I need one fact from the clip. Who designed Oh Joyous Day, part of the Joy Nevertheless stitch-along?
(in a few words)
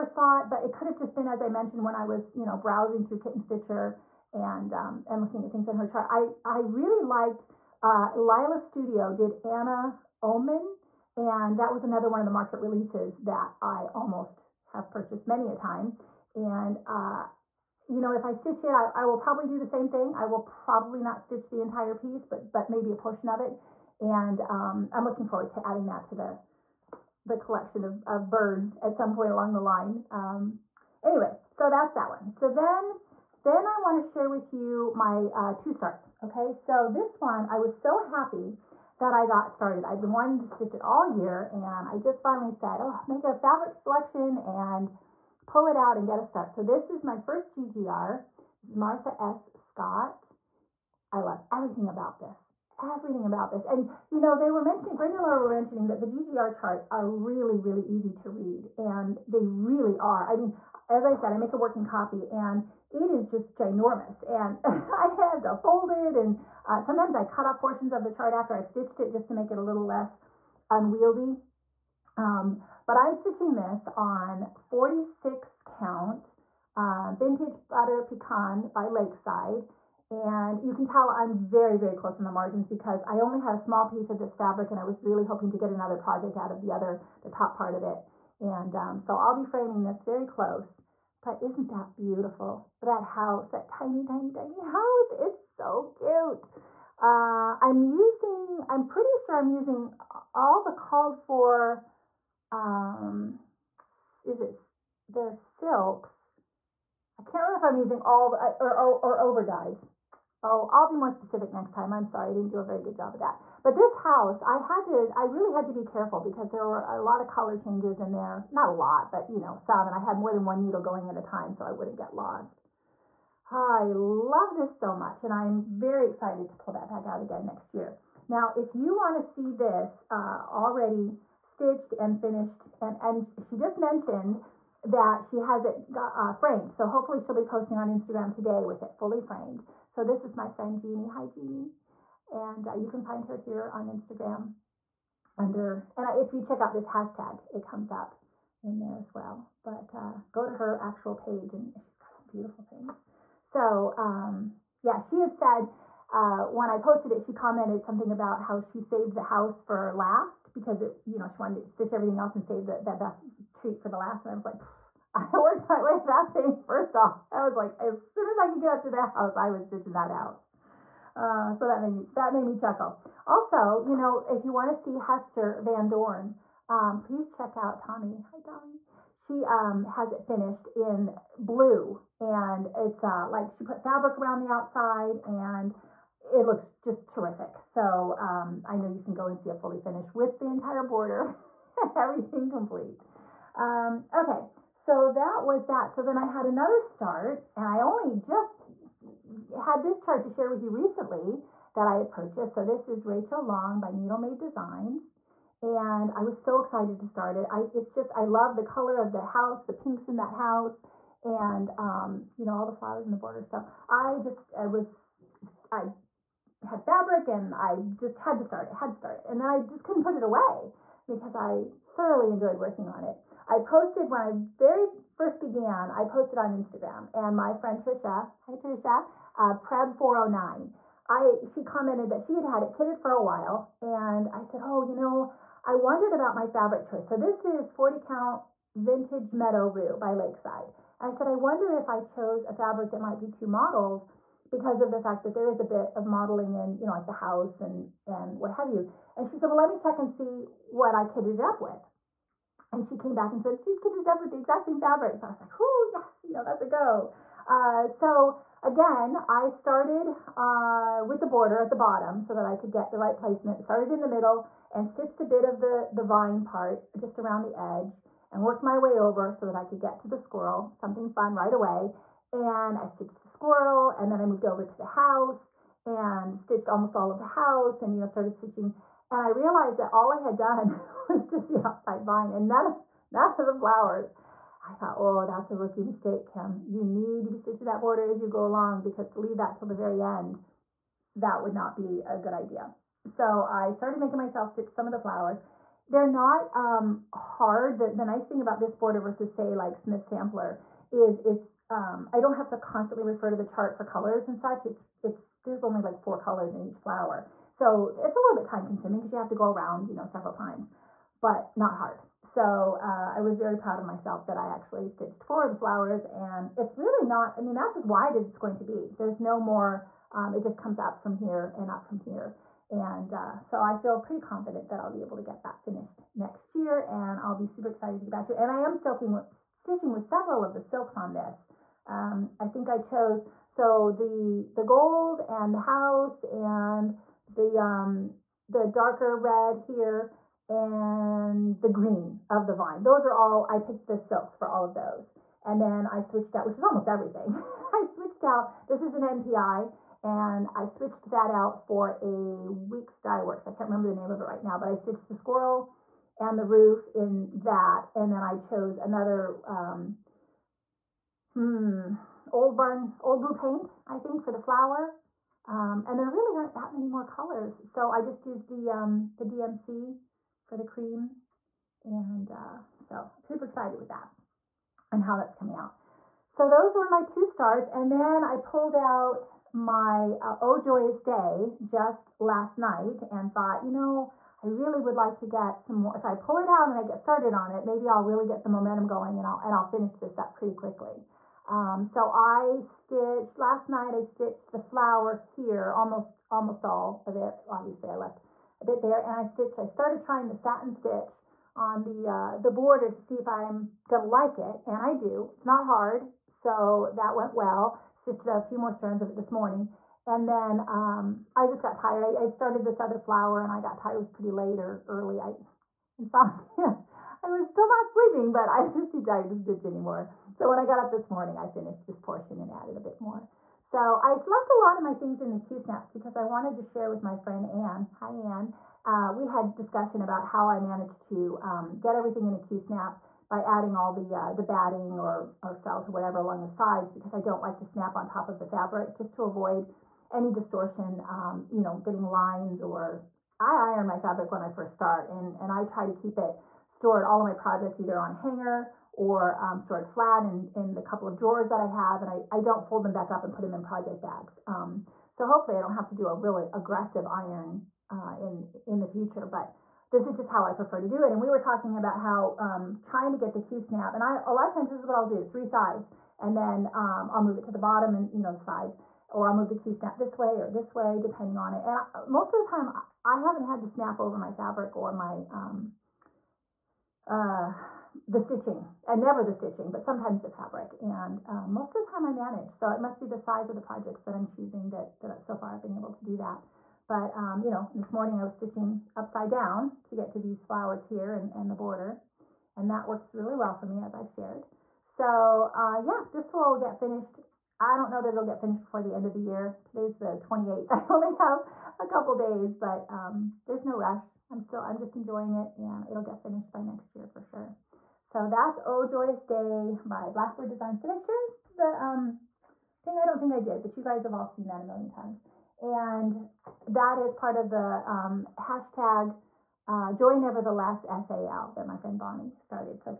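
Blackbird Designs.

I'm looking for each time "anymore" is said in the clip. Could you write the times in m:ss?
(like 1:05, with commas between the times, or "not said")
6:59.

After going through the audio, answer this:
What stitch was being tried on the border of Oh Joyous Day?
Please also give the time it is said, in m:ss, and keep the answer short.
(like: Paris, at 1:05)
satin stitch, at 6:40.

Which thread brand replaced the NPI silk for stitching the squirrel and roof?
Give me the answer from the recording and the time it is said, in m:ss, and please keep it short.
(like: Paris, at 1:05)
Weeks Dyeworks, at 5:52.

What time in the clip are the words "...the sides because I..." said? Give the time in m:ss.
7:16.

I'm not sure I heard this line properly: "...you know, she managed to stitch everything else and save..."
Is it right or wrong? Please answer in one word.
wrong.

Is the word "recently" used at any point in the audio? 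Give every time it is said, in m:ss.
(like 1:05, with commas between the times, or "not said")
3:20.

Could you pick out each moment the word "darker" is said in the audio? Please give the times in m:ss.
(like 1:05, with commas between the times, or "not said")
5:38.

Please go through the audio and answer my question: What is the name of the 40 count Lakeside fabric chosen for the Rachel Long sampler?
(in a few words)
vintage meadow rue.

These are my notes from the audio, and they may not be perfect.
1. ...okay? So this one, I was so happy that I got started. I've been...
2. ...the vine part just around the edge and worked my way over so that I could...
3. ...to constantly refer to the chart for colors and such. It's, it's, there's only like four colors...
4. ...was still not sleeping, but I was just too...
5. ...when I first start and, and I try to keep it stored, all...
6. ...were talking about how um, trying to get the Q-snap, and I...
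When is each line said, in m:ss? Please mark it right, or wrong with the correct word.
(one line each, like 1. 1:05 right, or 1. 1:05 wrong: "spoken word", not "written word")
1. 0:36 right
2. 4:25 right
3. 5:02 right
4. 6:57 right
5. 7:24 right
6. 7:41 right.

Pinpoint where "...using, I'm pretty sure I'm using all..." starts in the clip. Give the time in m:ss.
1:37.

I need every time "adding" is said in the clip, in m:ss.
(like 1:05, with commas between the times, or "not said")
0:25, 7:13.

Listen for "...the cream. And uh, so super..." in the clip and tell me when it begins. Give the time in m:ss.
6:10.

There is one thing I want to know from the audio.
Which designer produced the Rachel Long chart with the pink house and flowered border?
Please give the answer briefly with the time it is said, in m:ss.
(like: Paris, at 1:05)
Needle Made Designs, at 3:23.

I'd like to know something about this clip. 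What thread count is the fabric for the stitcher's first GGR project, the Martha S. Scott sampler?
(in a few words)
46.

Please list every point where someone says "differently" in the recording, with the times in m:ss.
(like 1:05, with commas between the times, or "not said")
not said.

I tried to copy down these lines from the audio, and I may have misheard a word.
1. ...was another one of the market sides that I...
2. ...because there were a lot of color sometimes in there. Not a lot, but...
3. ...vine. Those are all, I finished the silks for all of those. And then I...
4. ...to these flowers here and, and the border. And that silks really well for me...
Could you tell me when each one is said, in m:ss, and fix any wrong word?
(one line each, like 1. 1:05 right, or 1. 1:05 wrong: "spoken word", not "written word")
1. 0:11 wrong: "releases", not "sides"
2. 1:56 wrong: "changes", not "sometimes"
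3. 5:42 wrong: "picked", not "finished"
4. 8:10 wrong: "works", not "silks".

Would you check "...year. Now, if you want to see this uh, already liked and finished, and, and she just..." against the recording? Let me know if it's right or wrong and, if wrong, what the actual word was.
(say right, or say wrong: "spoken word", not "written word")
wrong: "stitched", not "liked".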